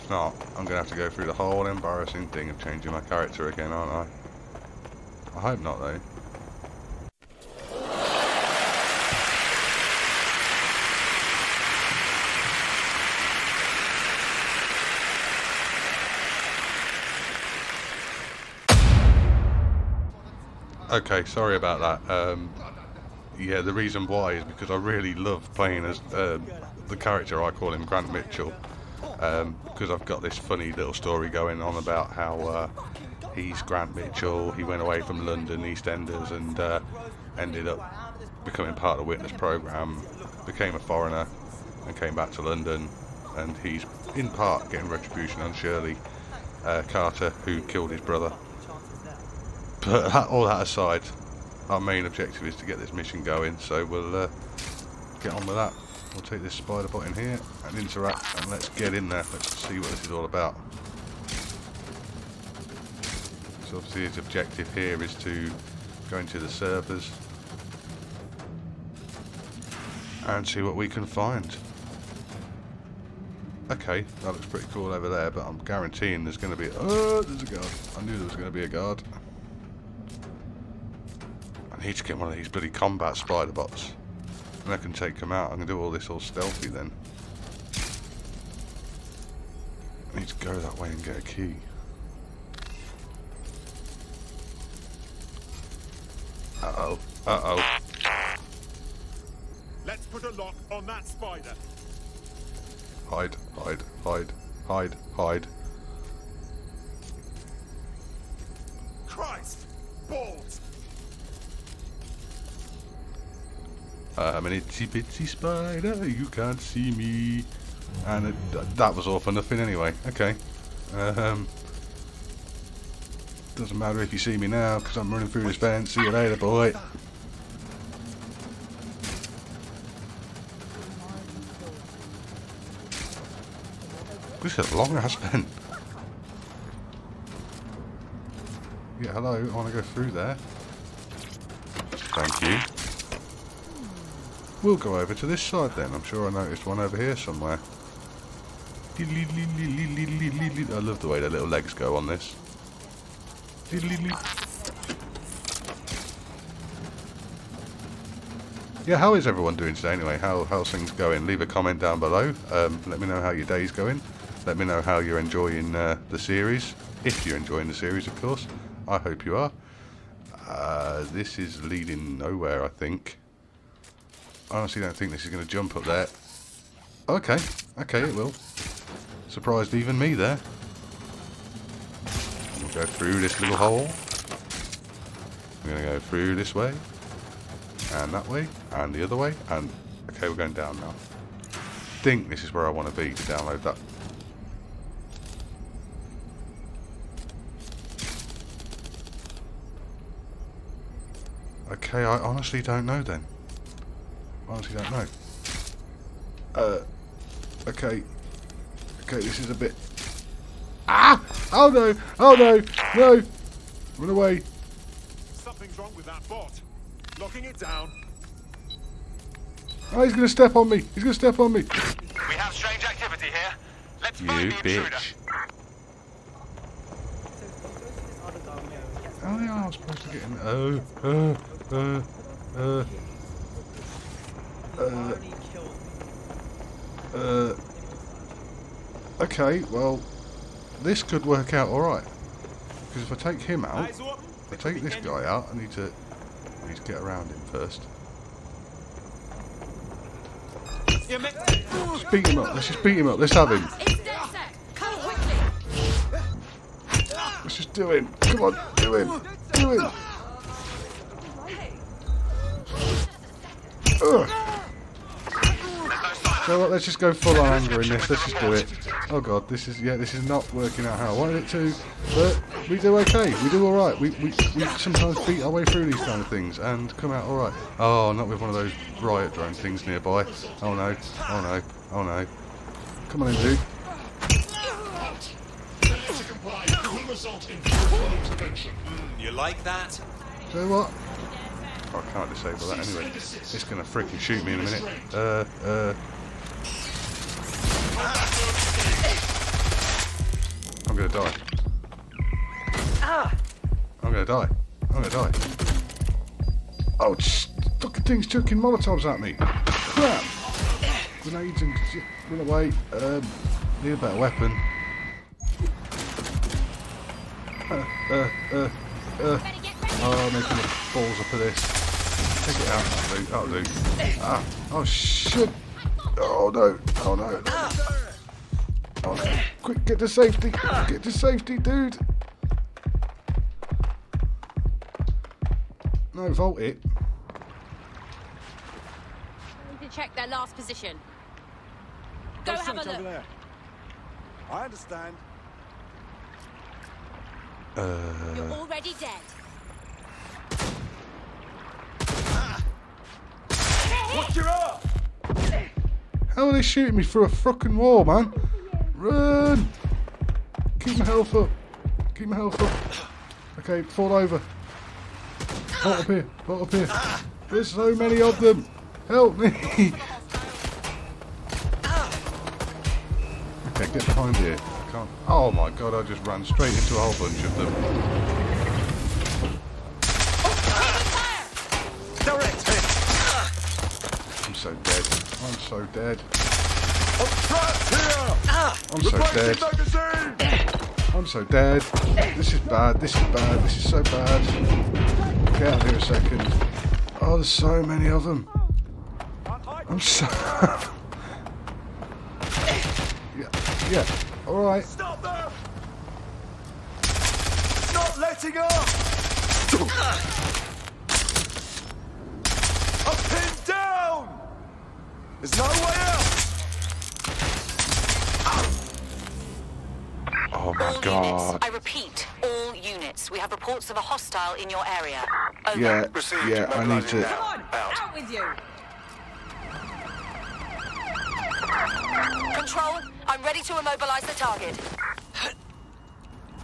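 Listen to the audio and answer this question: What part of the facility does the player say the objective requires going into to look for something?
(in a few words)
the servers.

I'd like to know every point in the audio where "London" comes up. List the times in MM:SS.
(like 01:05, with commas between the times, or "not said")
00:35, 00:42.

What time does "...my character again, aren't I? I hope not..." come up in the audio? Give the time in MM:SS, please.
00:02.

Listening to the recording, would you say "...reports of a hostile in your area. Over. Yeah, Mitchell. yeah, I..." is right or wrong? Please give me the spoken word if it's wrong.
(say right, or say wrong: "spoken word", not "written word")
wrong: "Received", not "Mitchell".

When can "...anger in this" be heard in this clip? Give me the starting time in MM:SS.
04:27.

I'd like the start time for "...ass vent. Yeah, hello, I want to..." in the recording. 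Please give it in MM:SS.
02:14.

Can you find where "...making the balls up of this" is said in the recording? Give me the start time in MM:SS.
05:20.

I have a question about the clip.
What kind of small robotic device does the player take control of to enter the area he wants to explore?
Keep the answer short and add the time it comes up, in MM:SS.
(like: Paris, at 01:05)
spider bot, at 00:56.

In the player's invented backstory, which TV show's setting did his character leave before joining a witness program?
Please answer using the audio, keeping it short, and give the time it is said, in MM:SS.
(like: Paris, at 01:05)
EastEnders, at 00:35.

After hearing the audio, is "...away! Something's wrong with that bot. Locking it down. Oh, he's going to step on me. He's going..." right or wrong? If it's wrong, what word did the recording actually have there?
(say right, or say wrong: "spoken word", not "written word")
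right.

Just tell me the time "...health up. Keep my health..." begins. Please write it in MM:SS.
06:01.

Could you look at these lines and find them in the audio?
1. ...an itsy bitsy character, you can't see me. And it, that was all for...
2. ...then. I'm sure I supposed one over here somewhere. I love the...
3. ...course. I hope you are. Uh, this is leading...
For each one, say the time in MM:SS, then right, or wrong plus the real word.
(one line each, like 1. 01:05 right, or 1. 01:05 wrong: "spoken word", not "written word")
1. 01:54 wrong: "spider", not "character"
2. 02:25 wrong: "noticed", not "supposed"
3. 02:48 right.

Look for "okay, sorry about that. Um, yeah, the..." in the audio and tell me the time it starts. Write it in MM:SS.
00:20.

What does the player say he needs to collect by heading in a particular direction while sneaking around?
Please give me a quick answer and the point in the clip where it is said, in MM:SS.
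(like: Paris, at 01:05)
a key, at 01:31.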